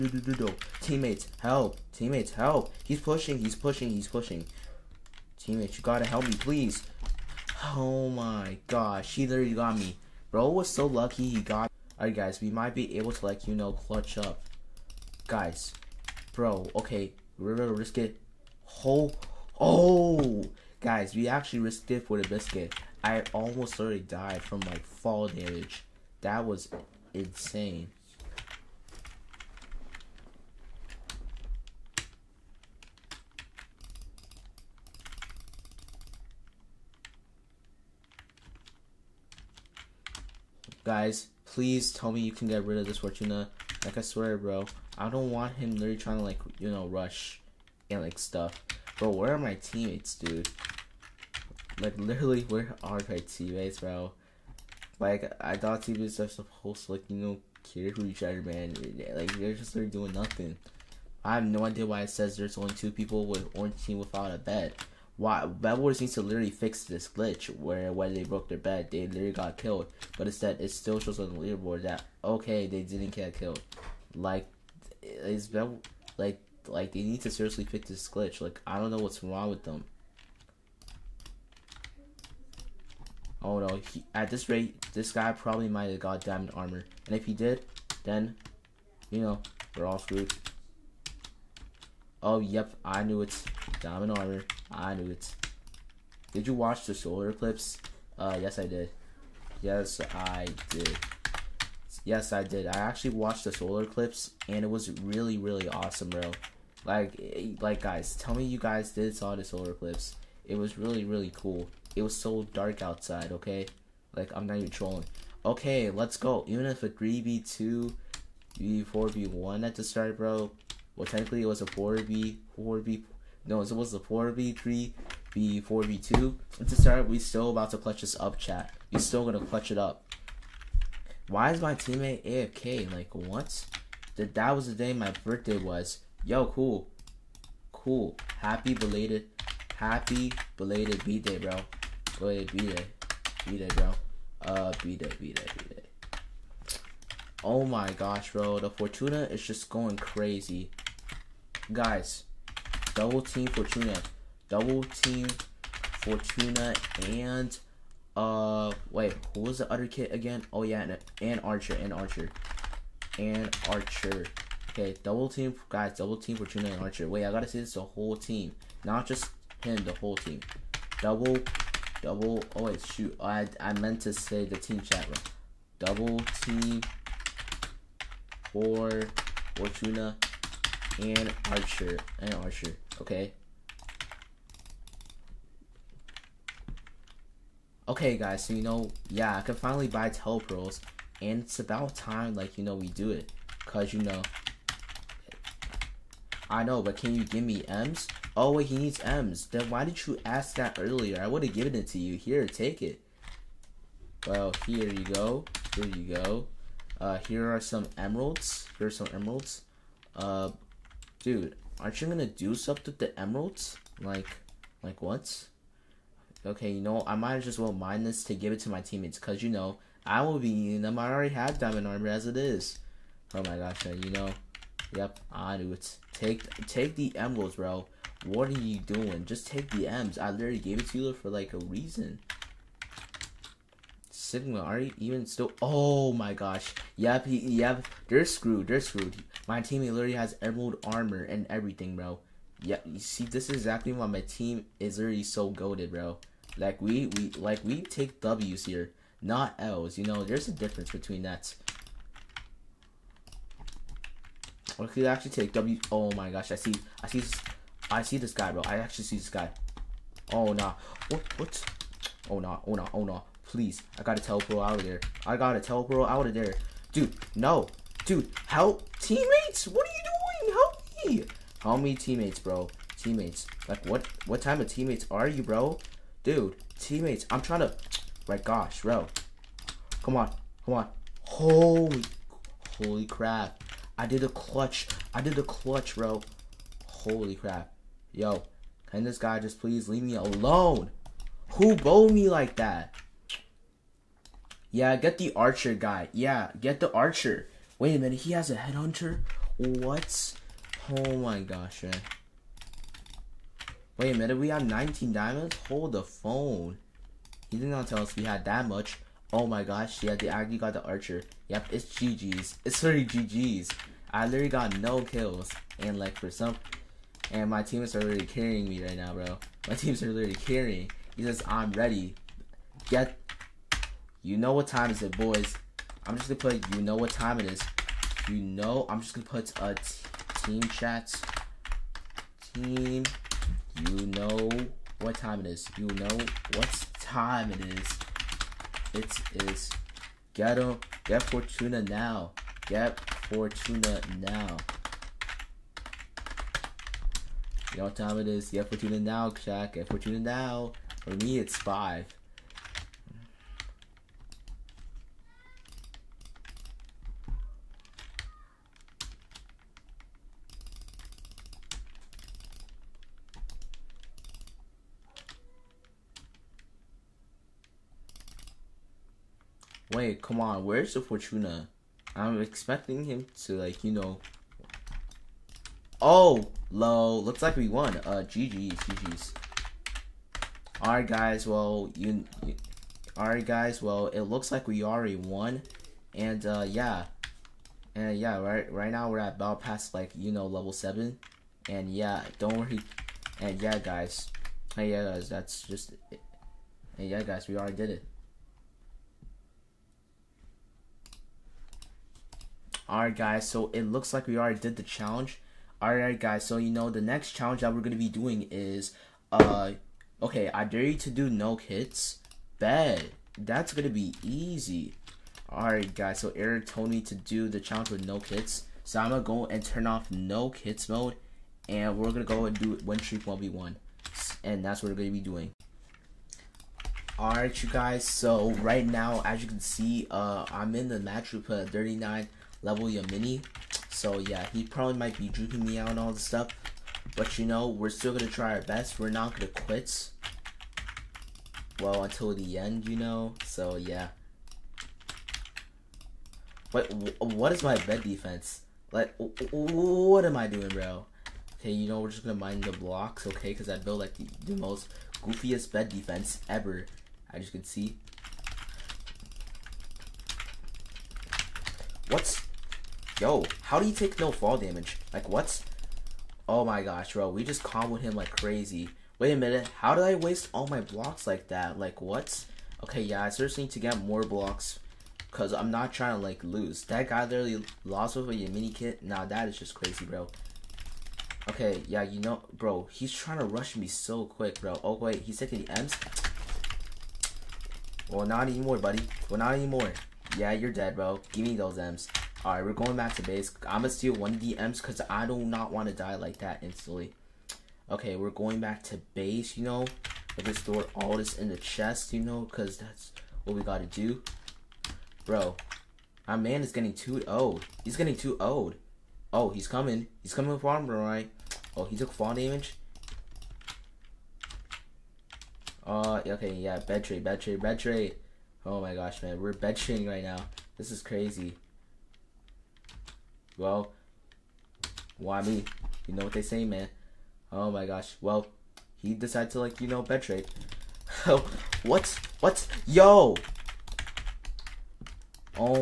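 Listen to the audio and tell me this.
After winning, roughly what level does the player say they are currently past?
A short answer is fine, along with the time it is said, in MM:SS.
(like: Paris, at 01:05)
Level 7, at 06:30.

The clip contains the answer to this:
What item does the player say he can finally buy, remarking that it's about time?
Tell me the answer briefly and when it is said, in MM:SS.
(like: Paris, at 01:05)
Telepearls, at 03:10.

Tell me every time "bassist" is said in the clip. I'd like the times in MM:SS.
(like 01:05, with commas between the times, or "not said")
not said.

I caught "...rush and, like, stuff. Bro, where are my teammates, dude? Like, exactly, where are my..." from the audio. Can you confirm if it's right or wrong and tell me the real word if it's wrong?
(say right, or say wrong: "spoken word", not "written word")
wrong: "literally", not "exactly".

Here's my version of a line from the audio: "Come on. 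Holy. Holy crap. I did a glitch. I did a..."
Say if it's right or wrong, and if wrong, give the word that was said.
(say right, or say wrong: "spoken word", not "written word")
wrong: "clutch", not "glitch".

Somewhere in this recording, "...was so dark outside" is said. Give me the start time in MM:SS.
01:52.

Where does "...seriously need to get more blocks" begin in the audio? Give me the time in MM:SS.
07:53.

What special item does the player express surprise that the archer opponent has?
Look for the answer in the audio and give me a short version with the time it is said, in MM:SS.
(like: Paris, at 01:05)
Headhunter, at 04:58.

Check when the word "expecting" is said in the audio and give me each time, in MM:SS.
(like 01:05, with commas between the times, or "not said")
06:12.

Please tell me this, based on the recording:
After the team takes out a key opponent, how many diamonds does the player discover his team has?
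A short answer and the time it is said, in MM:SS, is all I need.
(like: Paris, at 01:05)
19, at 05:04.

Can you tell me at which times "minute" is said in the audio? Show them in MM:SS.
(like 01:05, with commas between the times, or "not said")
04:57, 05:04, 07:49.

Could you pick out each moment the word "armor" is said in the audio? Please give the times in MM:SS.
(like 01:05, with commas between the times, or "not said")
01:26, 01:34, 03:41, 04:00, 08:30.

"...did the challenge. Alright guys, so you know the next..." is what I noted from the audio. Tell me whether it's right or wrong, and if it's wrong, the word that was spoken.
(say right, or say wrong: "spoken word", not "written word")
right.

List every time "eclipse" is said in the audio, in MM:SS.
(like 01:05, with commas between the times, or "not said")
01:37, 01:43, 01:49.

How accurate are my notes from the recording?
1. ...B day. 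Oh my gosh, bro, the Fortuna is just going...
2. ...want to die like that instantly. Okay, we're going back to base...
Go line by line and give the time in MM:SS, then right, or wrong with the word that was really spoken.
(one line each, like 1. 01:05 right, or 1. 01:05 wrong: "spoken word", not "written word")
1. 02:25 right
2. 08:15 right.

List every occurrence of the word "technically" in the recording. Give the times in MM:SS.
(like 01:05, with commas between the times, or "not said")
02:01.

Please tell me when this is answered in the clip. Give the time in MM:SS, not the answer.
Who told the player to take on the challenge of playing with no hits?
06:56.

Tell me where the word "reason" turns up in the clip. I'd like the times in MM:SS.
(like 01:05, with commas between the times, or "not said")
03:51.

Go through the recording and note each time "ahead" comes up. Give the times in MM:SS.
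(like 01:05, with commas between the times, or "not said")
02:22.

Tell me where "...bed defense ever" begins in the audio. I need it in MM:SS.
07:35.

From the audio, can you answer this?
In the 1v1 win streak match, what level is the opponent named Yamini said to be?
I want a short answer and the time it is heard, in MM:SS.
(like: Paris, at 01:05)
39, at 07:11.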